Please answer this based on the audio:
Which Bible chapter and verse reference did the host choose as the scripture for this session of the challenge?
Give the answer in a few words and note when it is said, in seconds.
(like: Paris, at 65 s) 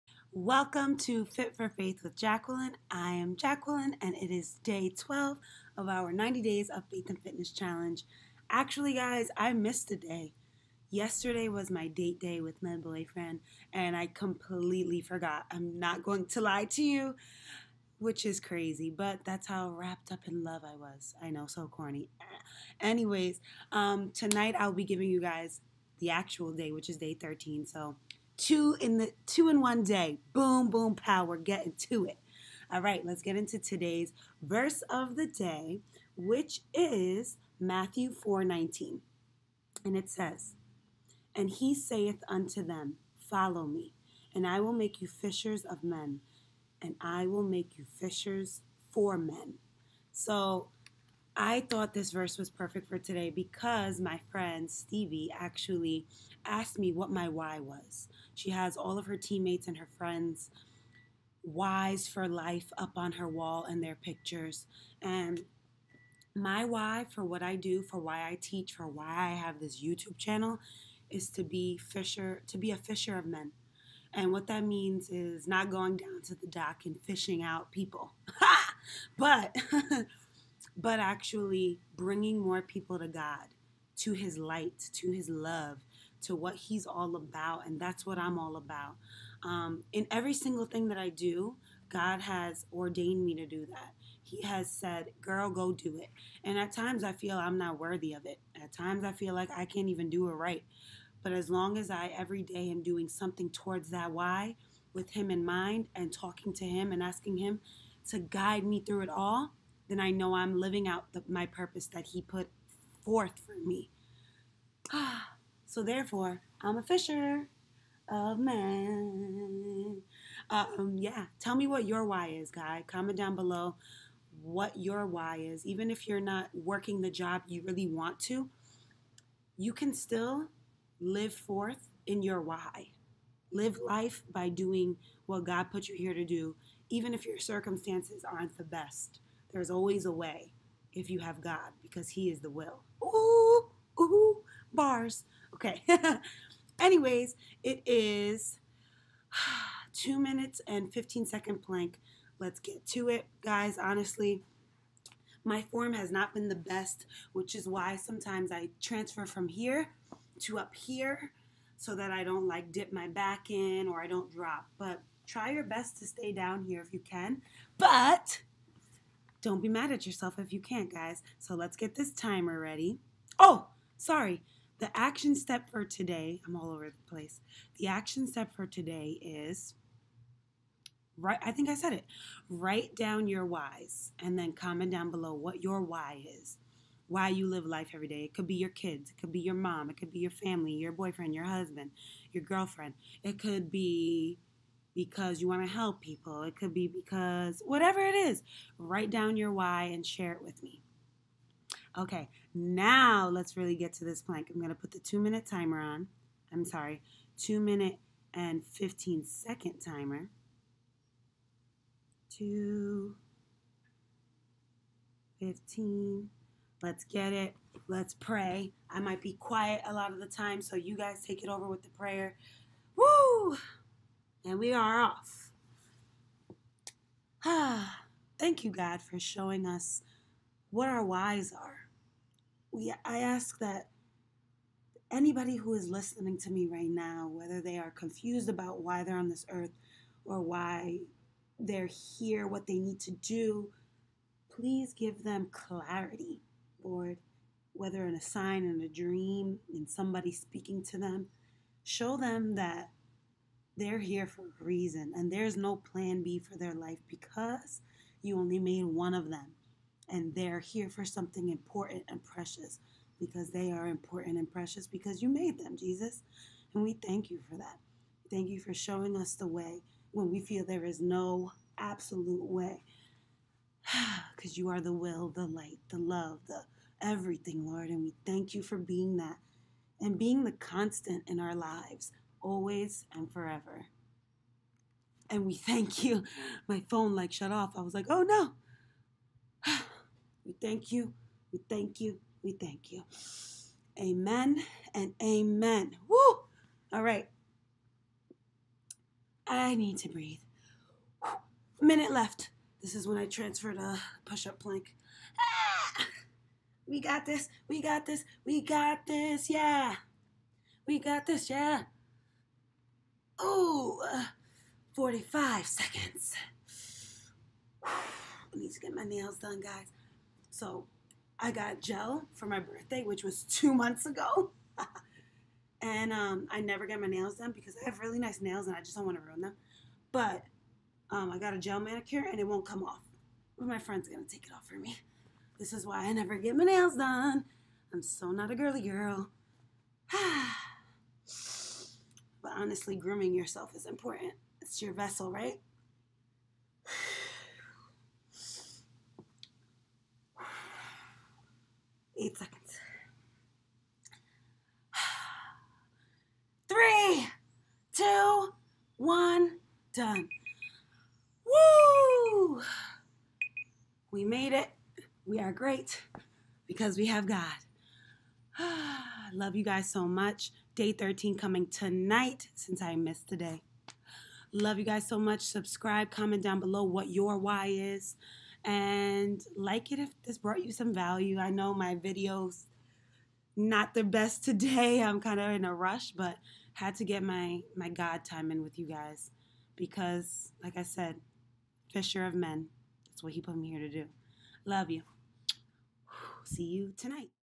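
Matthew 4:19, at 37 s.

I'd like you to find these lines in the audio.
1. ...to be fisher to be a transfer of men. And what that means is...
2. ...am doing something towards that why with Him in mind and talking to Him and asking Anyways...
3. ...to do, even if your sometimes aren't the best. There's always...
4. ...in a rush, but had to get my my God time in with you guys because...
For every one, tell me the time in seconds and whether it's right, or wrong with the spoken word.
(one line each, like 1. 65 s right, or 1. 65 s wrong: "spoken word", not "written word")
1. 71 s wrong: "fisher", not "transfer"
2. 102 s wrong: "Him", not "Anyways"
3. 136 s wrong: "circumstances", not "sometimes"
4. 385 s right.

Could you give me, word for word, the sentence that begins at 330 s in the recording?
But um, I got a gel manicure and it won't come off.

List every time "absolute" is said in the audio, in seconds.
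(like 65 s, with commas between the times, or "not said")
271 s.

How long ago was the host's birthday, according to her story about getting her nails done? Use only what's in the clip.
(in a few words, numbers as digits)
two months.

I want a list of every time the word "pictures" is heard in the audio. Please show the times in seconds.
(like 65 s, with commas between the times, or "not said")
63 s.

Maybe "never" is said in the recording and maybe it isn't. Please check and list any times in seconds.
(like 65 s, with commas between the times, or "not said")
326 s, 336 s.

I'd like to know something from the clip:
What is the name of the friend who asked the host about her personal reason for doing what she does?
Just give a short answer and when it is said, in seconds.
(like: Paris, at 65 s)
Stevie, at 54 s.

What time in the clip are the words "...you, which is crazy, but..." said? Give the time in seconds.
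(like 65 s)
16 s.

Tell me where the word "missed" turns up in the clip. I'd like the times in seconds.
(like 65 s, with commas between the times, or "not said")
9 s, 372 s.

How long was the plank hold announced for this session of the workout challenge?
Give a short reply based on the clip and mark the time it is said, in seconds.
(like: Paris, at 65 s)
2 minutes and 15 seconds, at 149 s.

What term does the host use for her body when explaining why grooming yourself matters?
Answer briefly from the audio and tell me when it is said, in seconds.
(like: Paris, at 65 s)
vessel, at 344 s.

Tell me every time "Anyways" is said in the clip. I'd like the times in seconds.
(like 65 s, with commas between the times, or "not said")
22 s, 146 s.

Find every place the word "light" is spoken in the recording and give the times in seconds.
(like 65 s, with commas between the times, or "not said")
84 s, 275 s.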